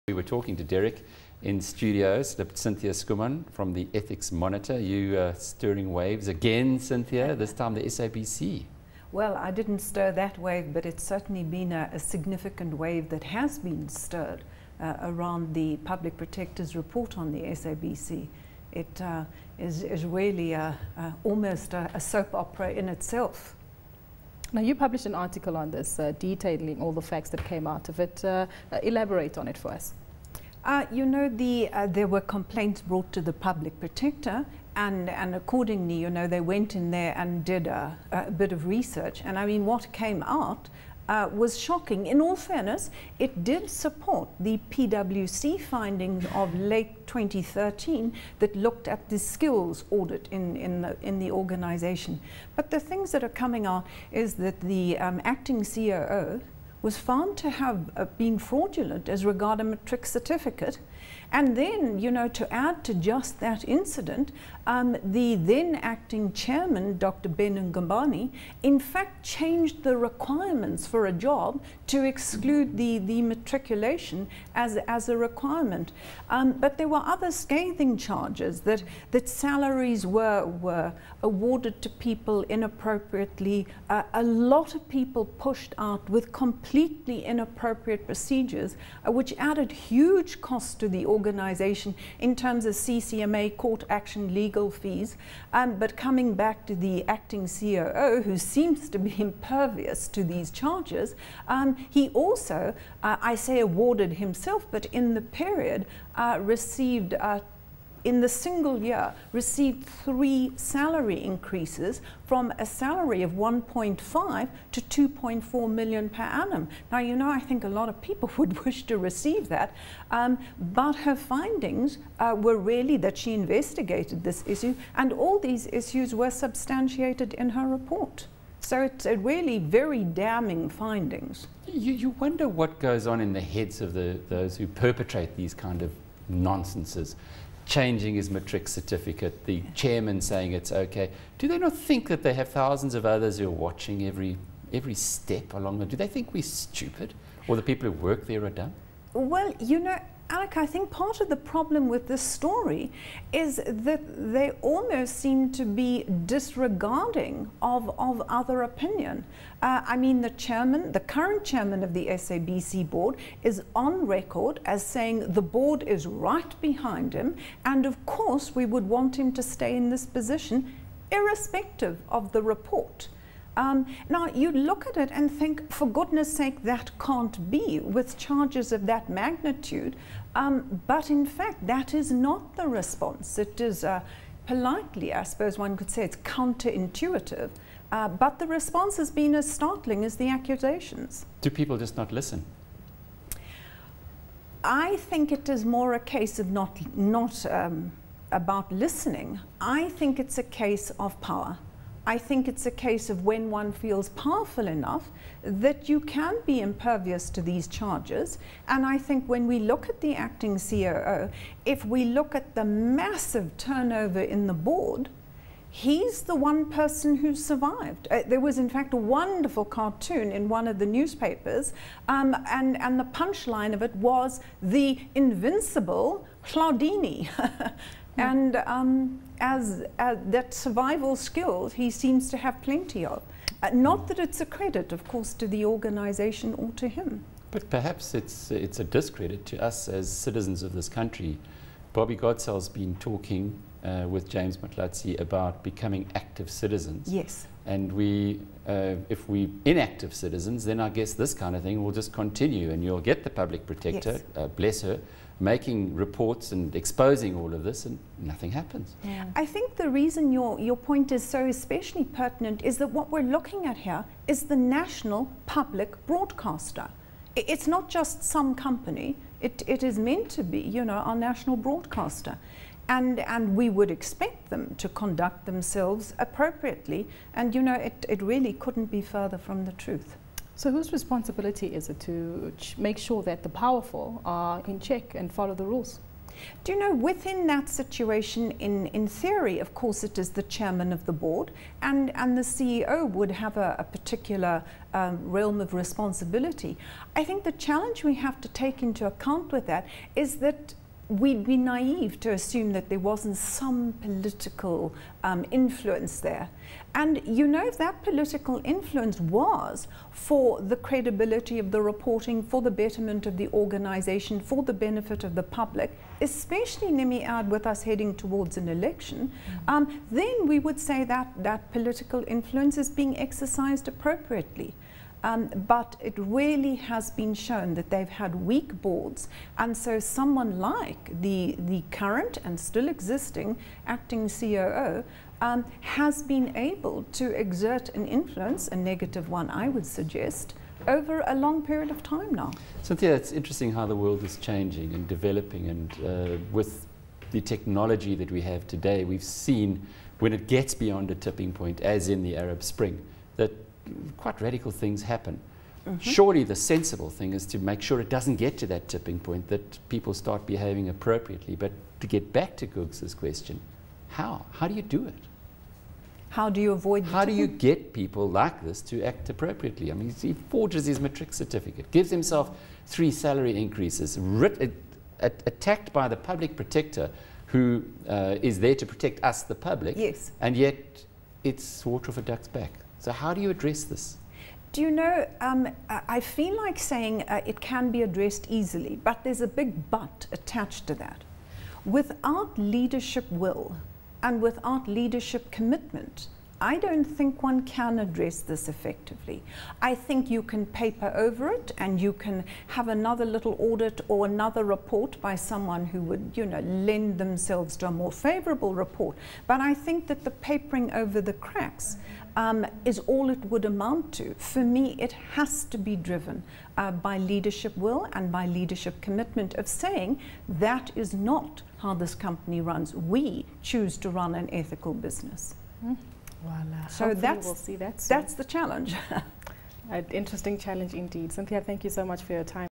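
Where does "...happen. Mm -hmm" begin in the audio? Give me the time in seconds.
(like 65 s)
355 s.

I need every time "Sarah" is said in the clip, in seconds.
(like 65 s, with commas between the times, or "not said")
not said.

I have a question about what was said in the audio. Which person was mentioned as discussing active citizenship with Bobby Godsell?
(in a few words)
James Motlatsi.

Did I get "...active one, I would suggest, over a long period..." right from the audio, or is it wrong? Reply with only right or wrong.
wrong.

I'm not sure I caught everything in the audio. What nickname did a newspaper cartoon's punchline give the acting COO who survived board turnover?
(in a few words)
the invincible Hlaudini.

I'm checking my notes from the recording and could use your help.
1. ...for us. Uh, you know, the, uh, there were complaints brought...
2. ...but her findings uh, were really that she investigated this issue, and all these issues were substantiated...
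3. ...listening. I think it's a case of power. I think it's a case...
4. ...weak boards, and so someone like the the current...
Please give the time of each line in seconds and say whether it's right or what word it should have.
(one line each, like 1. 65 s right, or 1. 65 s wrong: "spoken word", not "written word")
1. 29 s right
2. 120 s right
3. 198 s right
4. 328 s right.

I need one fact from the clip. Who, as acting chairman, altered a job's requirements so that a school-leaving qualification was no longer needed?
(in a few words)
Dr. Ben Ngubane.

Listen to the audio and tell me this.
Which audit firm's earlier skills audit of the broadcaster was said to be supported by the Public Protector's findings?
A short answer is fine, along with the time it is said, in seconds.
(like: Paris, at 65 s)
PwC, at 44 s.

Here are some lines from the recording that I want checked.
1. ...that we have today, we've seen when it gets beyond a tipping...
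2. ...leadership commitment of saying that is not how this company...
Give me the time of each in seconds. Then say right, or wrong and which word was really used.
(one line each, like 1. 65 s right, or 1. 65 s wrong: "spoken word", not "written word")
1. 348 s right
2. 418 s right.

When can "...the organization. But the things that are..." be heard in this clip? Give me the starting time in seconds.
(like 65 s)
51 s.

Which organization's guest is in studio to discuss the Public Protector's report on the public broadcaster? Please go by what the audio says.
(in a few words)
Ethics Monitor.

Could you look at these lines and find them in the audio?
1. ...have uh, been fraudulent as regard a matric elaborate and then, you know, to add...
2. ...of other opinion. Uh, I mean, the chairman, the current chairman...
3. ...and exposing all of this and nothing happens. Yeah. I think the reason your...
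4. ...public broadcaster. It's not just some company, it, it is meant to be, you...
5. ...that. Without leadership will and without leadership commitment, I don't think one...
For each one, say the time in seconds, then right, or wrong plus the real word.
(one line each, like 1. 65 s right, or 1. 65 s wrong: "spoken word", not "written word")
1. 57 s wrong: "certificate", not "elaborate"
2. 157 s right
3. 256 s right
4. 265 s right
5. 390 s right.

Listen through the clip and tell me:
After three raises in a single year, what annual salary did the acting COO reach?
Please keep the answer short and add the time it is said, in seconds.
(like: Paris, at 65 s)
2.4 million, at 114 s.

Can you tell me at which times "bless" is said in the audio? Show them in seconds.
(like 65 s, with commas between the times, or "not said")
254 s.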